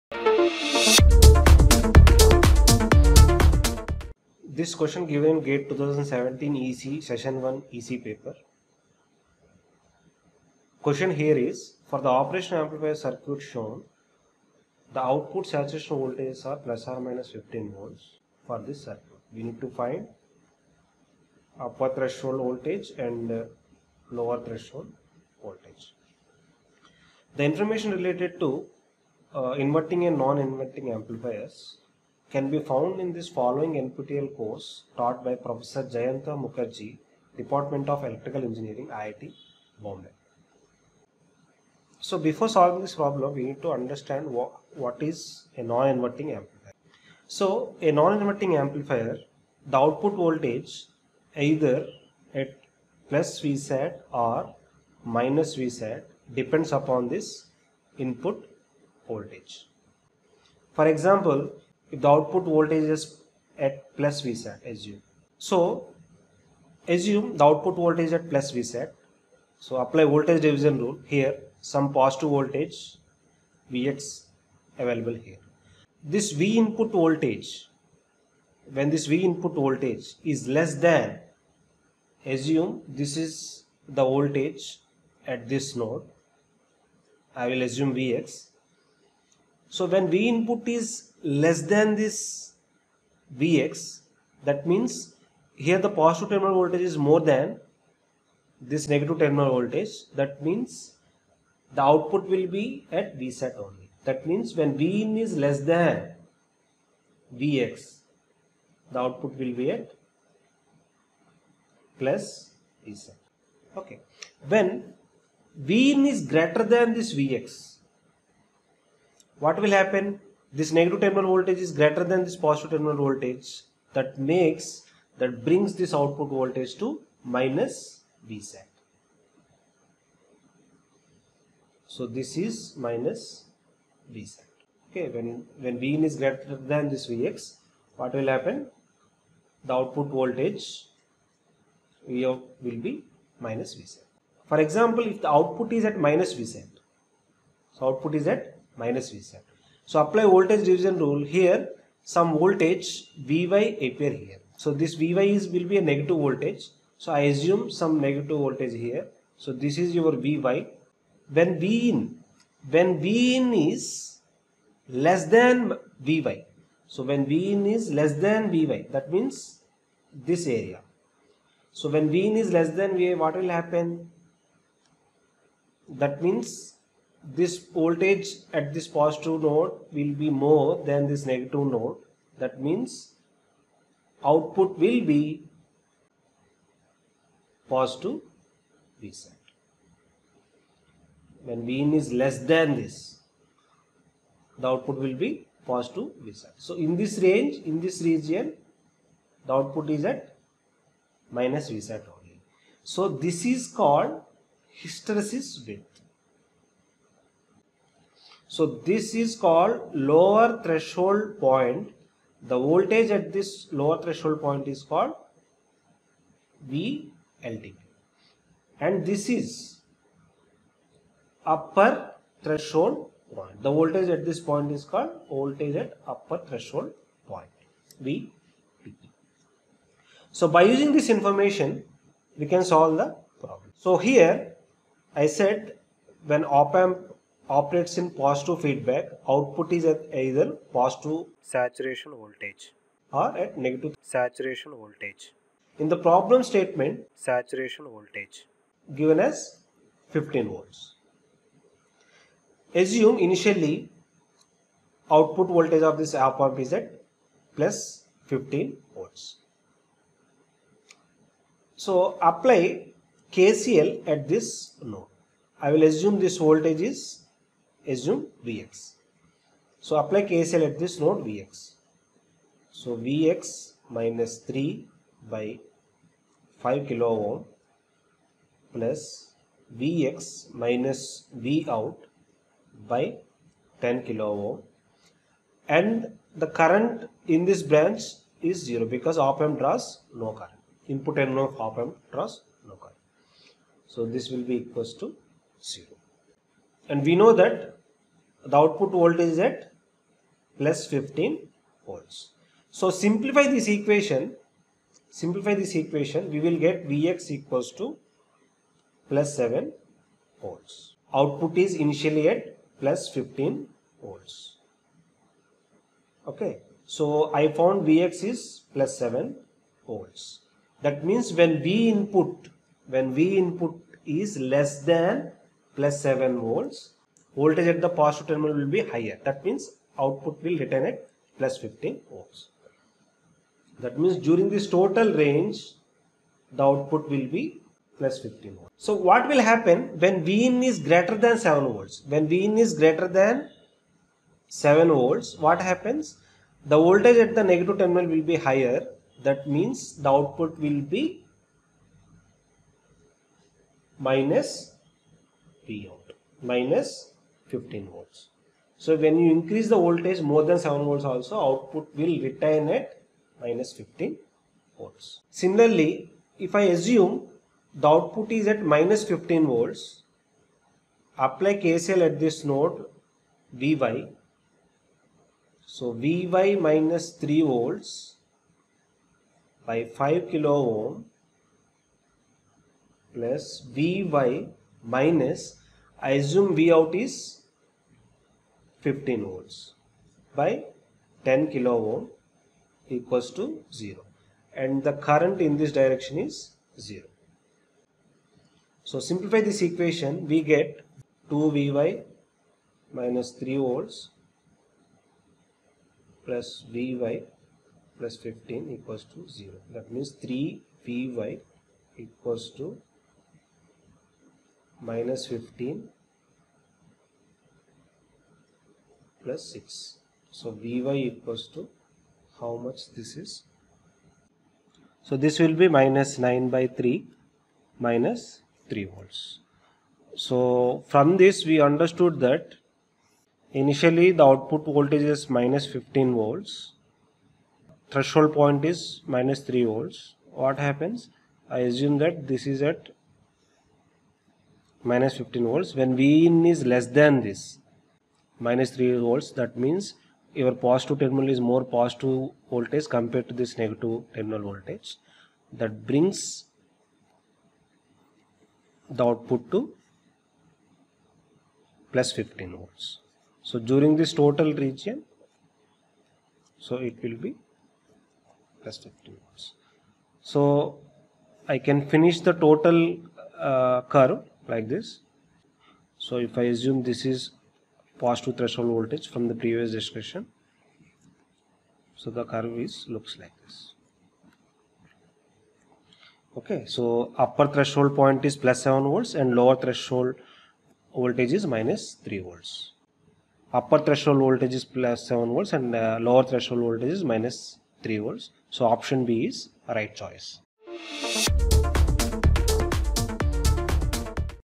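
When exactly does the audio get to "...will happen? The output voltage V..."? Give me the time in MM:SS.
02:18.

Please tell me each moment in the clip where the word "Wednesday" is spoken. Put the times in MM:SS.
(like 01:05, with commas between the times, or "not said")
not said.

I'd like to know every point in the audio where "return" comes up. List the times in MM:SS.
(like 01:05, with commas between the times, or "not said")
05:30.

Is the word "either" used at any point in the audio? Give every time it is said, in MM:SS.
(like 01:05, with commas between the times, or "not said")
00:51, 04:00.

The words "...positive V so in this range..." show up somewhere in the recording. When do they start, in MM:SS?
03:15.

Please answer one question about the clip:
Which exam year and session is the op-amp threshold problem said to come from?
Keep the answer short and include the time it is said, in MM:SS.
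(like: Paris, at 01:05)
GATE 2017 EC session 1, at 00:05.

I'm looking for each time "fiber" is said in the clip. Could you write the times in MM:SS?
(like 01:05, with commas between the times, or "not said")
not said.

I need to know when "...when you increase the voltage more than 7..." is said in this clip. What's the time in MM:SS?
05:58.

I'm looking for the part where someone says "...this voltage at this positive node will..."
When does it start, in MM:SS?
02:57.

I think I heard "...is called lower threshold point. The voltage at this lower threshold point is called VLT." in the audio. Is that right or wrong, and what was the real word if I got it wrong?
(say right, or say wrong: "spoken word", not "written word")
right.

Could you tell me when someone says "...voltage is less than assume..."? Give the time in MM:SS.
01:19.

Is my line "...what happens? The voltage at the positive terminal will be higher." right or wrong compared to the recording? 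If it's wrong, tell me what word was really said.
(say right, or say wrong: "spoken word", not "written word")
wrong: "negative", not "positive".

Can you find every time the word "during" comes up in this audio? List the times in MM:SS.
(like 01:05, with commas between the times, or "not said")
05:34, 07:43.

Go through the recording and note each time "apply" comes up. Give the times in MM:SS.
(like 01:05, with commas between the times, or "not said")
01:09, 02:30, 04:22, 04:29, 06:11.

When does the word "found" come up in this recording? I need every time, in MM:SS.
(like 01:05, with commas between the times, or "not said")
00:32, 05:17.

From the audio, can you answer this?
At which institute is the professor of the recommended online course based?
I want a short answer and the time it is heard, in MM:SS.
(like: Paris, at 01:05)
IIT Bombay, at 00:38.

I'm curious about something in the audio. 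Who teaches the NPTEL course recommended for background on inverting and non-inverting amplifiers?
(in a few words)
Jayanta Mukherjee.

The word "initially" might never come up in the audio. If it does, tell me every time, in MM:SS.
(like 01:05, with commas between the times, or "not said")
04:13, 05:11, 07:13.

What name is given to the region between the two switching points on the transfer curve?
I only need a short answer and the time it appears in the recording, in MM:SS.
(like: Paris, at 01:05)
hysteresis width, at 03:24.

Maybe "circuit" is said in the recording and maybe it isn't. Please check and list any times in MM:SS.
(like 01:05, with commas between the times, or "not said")
00:12, 00:18.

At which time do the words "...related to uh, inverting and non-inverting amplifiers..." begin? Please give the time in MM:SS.
00:27.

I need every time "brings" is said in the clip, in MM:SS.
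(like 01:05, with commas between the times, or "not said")
02:05, 07:35.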